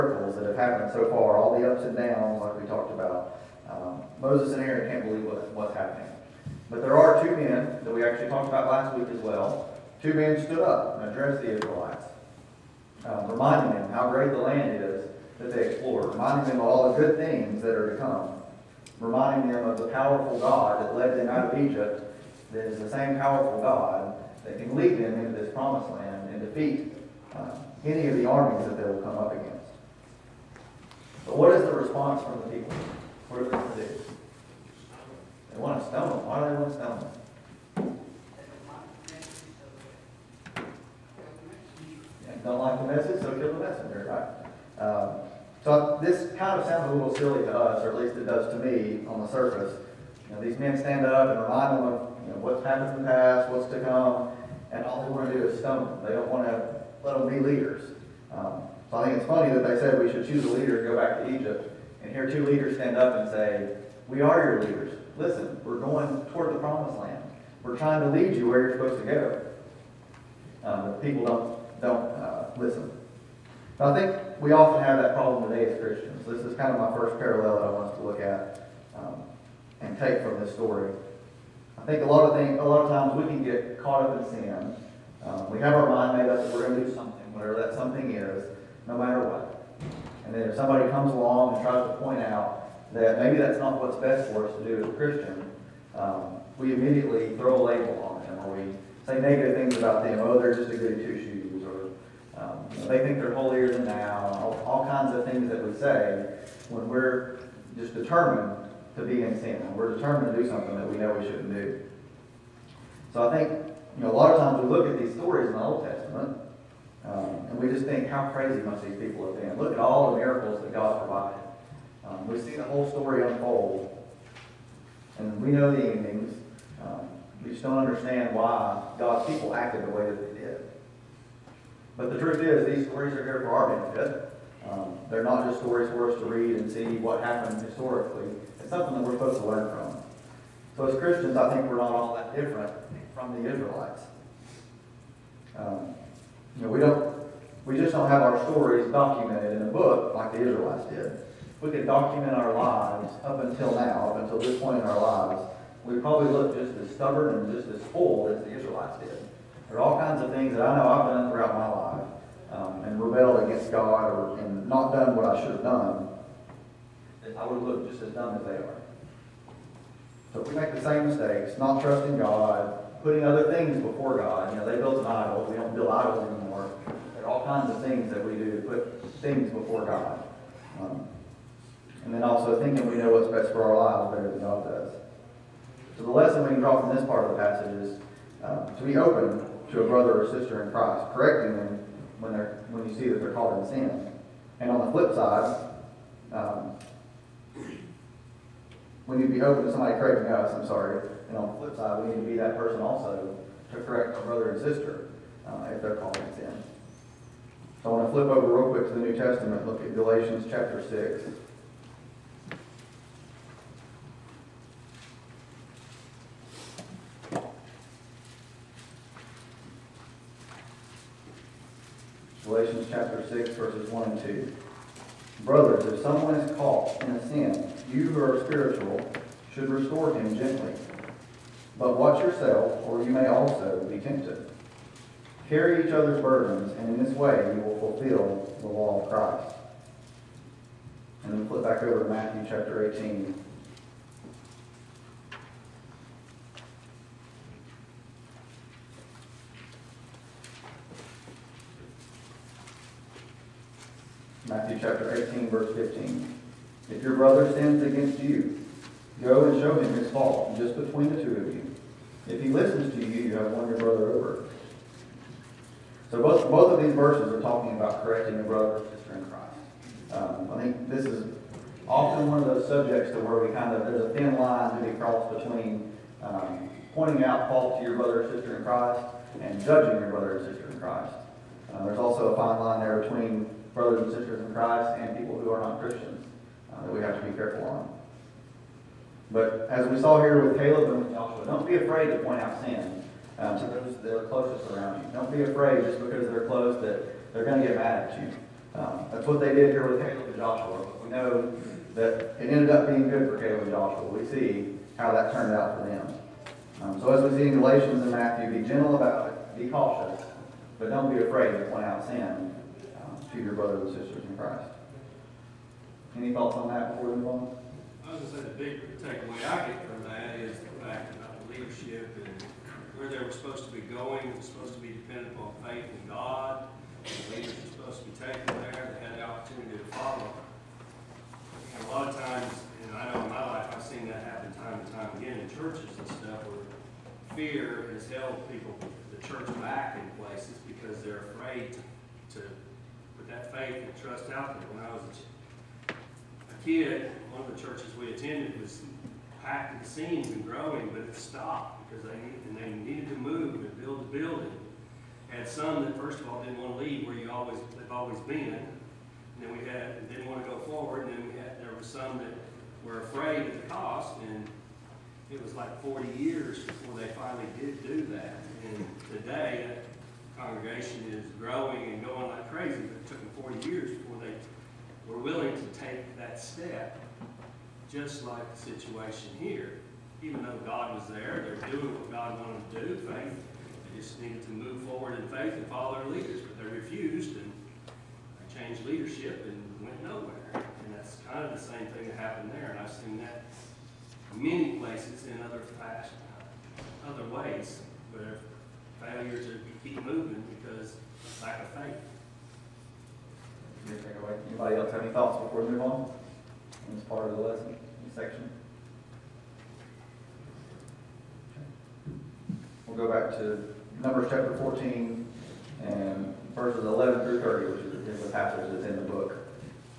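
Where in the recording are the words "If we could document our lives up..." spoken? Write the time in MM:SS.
02:31.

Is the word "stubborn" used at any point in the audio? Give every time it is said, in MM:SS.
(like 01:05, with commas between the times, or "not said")
02:36.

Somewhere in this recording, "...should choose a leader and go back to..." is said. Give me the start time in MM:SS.
01:00.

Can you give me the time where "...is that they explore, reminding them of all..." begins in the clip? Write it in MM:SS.
00:14.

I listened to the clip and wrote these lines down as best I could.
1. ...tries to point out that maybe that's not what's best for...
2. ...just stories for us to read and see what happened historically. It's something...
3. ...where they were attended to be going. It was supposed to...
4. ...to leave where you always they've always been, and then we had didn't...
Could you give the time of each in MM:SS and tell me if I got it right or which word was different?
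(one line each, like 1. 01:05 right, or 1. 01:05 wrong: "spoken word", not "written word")
1. 01:31 right
2. 02:15 right
3. 05:22 wrong: "supposed", not "attended"
4. 05:56 right.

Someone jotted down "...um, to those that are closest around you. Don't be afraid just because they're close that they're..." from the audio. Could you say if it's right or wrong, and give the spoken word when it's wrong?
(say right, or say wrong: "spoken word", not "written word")
right.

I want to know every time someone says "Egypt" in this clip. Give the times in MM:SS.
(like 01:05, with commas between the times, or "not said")
00:21, 01:01.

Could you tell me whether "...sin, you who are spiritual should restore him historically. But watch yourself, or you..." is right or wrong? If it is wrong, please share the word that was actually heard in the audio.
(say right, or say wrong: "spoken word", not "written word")
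wrong: "gently", not "historically".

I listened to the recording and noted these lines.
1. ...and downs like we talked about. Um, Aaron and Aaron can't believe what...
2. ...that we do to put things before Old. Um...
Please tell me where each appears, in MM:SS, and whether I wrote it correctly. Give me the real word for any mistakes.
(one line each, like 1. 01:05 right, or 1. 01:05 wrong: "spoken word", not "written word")
1. 00:01 wrong: "Moses", not "Aaron"
2. 02:58 wrong: "God", not "Old".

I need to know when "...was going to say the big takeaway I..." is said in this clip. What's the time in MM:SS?
05:18.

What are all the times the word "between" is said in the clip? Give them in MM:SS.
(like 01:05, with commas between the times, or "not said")
04:20, 04:35, 04:43.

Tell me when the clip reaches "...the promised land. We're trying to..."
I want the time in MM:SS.
01:06.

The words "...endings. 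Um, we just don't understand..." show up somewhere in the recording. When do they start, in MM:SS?
02:05.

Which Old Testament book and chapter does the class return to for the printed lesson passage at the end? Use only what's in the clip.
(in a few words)
Numbers 14.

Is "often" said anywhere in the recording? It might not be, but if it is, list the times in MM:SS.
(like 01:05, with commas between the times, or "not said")
01:14, 04:31.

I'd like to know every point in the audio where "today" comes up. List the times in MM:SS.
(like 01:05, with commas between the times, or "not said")
01:15, 06:09.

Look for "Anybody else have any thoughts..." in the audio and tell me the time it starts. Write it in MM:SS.
06:44.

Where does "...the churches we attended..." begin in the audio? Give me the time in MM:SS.
05:47.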